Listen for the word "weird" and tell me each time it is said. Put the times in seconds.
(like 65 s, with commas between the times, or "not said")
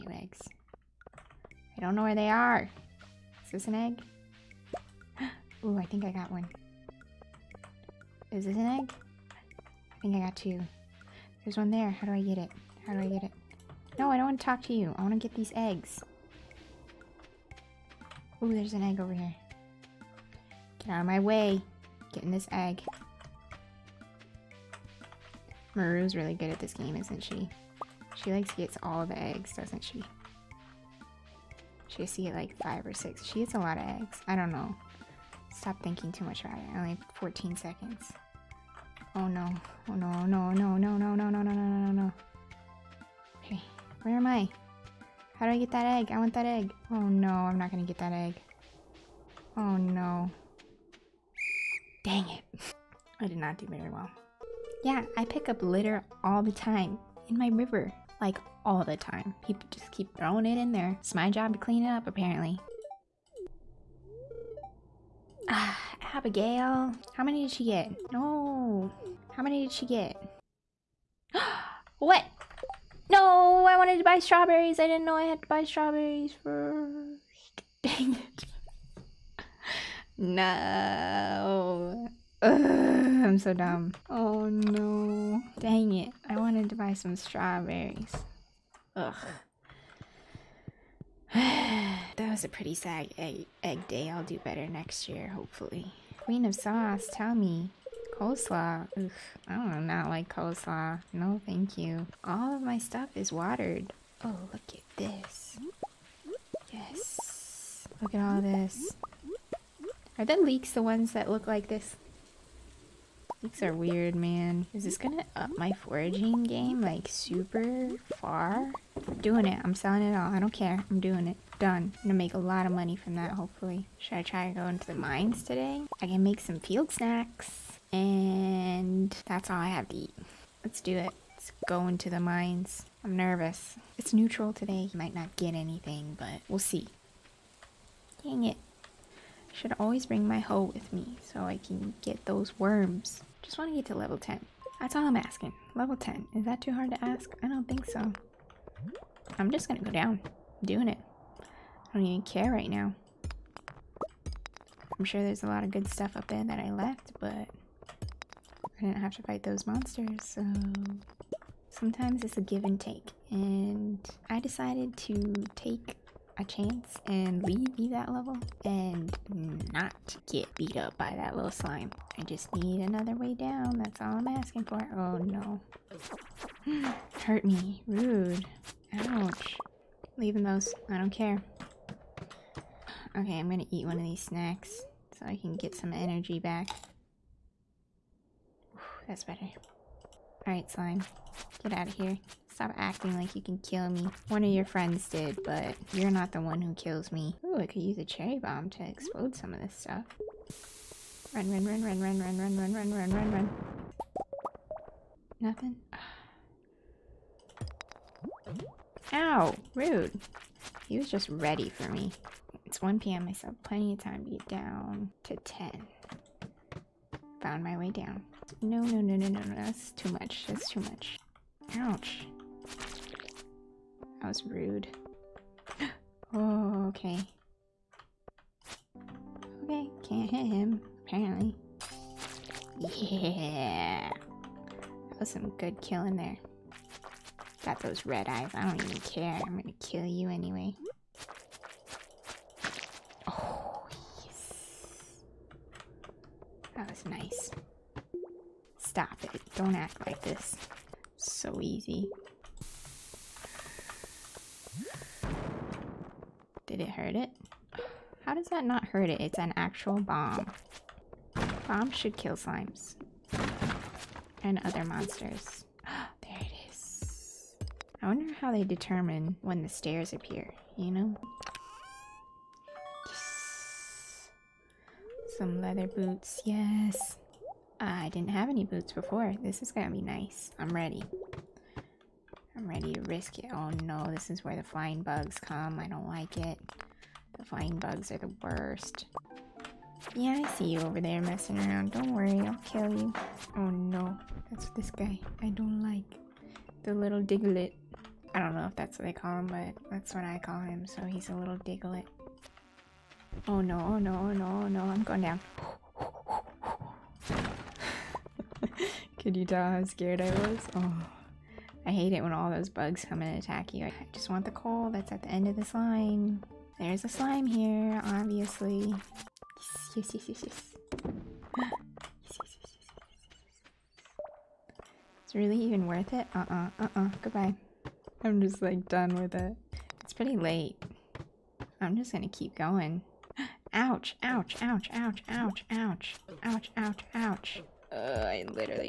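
113 s.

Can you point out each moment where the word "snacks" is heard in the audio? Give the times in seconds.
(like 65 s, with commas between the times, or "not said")
126 s, 184 s.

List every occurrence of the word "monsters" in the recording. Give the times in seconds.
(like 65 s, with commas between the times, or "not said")
159 s, 264 s.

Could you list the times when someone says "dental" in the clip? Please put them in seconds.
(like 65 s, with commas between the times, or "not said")
not said.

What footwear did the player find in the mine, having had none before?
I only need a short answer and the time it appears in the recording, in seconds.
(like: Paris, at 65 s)
leather boots, at 275 s.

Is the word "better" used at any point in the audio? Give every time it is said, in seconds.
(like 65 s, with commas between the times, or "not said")
94 s, 189 s.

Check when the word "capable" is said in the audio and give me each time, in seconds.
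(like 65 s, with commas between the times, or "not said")
not said.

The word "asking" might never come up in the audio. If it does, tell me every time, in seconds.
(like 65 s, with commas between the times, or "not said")
145 s, 174 s.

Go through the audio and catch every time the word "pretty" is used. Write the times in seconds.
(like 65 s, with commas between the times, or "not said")
92 s, 330 s.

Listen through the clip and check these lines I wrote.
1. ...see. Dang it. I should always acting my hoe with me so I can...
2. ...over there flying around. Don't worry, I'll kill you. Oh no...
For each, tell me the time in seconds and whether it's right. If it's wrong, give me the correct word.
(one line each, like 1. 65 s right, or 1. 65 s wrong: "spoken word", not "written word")
1. 136 s wrong: "bring", not "acting"
2. 290 s wrong: "messing", not "flying".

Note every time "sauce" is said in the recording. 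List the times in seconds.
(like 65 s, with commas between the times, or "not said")
96 s.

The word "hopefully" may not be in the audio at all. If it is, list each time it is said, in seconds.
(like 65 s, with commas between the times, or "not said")
95 s, 123 s.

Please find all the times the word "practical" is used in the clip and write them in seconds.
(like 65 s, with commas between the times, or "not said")
not said.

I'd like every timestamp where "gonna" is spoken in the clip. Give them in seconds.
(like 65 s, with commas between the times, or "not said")
47 s, 114 s, 122 s, 149 s, 183 s, 239 s, 279 s, 332 s.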